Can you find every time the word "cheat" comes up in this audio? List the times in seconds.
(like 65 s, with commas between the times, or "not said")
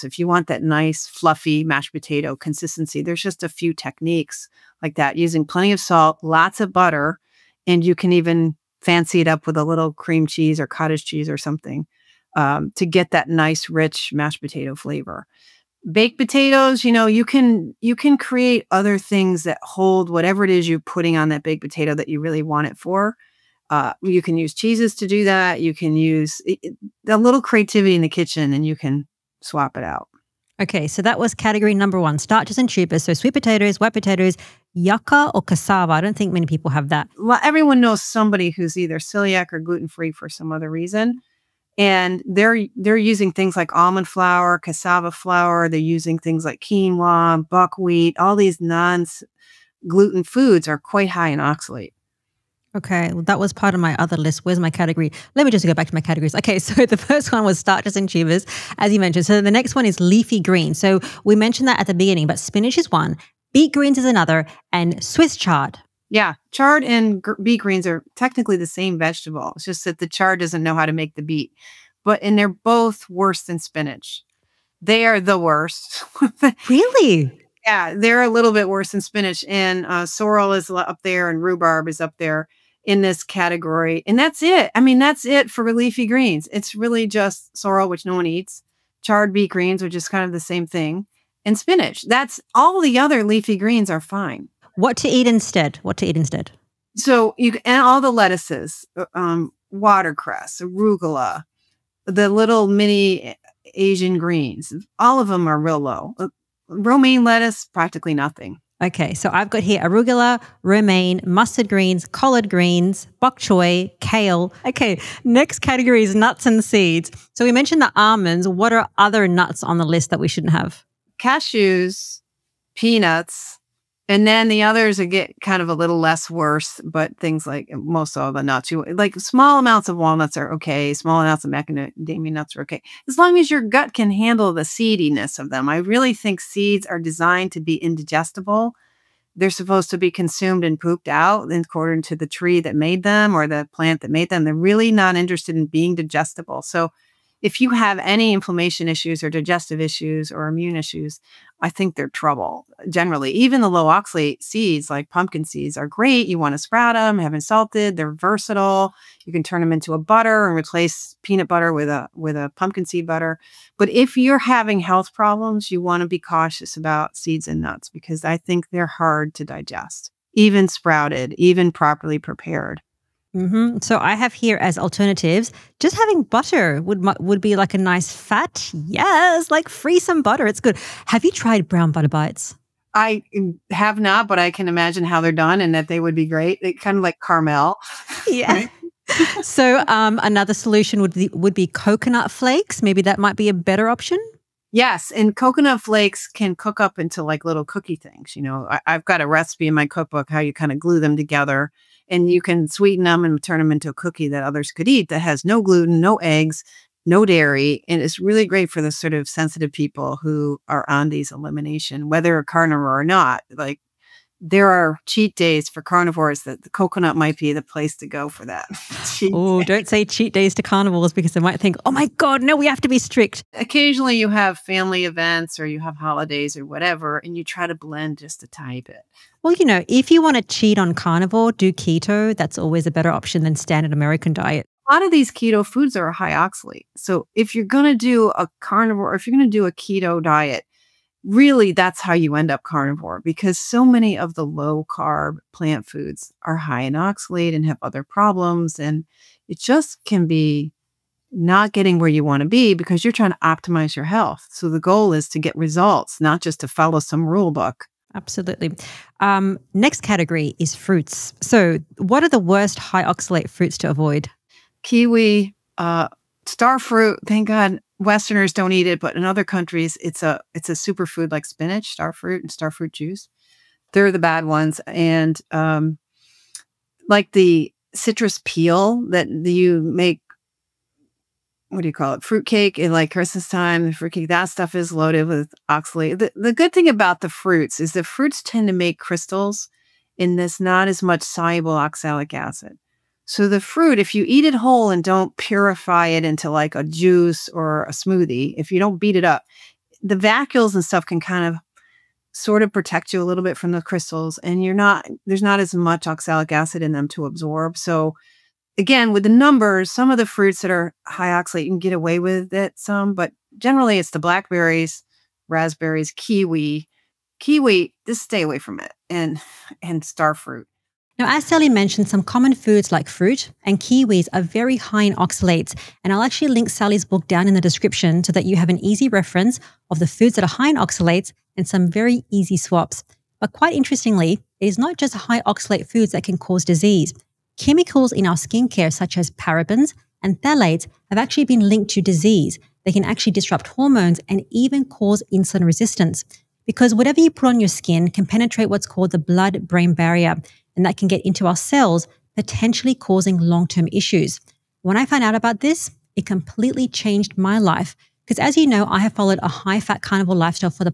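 215 s, 220 s, 230 s.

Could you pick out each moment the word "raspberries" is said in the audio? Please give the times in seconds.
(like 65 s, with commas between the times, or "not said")
315 s.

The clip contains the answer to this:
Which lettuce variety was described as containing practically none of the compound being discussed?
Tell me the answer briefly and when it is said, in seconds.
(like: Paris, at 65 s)
romaine lettuce, at 106 s.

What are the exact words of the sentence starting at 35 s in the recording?
I don't think many people have that.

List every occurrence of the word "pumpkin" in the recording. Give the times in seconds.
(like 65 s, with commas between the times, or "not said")
155 s, 162 s.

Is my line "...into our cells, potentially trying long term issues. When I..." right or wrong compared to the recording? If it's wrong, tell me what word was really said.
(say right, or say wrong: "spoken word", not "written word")
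wrong: "causing", not "trying".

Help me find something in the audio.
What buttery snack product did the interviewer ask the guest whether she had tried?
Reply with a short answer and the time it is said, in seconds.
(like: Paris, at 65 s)
brown butter bites, at 181 s.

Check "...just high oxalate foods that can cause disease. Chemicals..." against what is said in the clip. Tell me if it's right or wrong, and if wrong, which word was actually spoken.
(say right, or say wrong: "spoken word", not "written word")
right.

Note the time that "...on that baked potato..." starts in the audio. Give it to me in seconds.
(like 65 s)
21 s.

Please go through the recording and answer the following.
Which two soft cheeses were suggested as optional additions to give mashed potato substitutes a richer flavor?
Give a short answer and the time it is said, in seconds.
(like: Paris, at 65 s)
cream cheese or cottage cheese, at 9 s.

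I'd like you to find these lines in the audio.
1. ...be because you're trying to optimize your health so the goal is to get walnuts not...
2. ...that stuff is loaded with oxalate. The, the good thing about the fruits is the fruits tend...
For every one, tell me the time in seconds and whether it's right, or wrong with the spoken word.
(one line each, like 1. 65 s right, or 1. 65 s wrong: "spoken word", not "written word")
1. 252 s wrong: "results", not "walnuts"
2. 284 s right.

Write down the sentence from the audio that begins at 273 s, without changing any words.
They're the bad ones, and um, like the citrus peel that you make.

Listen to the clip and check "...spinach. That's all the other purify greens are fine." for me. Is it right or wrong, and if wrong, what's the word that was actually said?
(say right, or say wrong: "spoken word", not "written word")
wrong: "leafy", not "purify".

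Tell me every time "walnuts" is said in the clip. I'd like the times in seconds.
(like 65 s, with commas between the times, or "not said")
129 s.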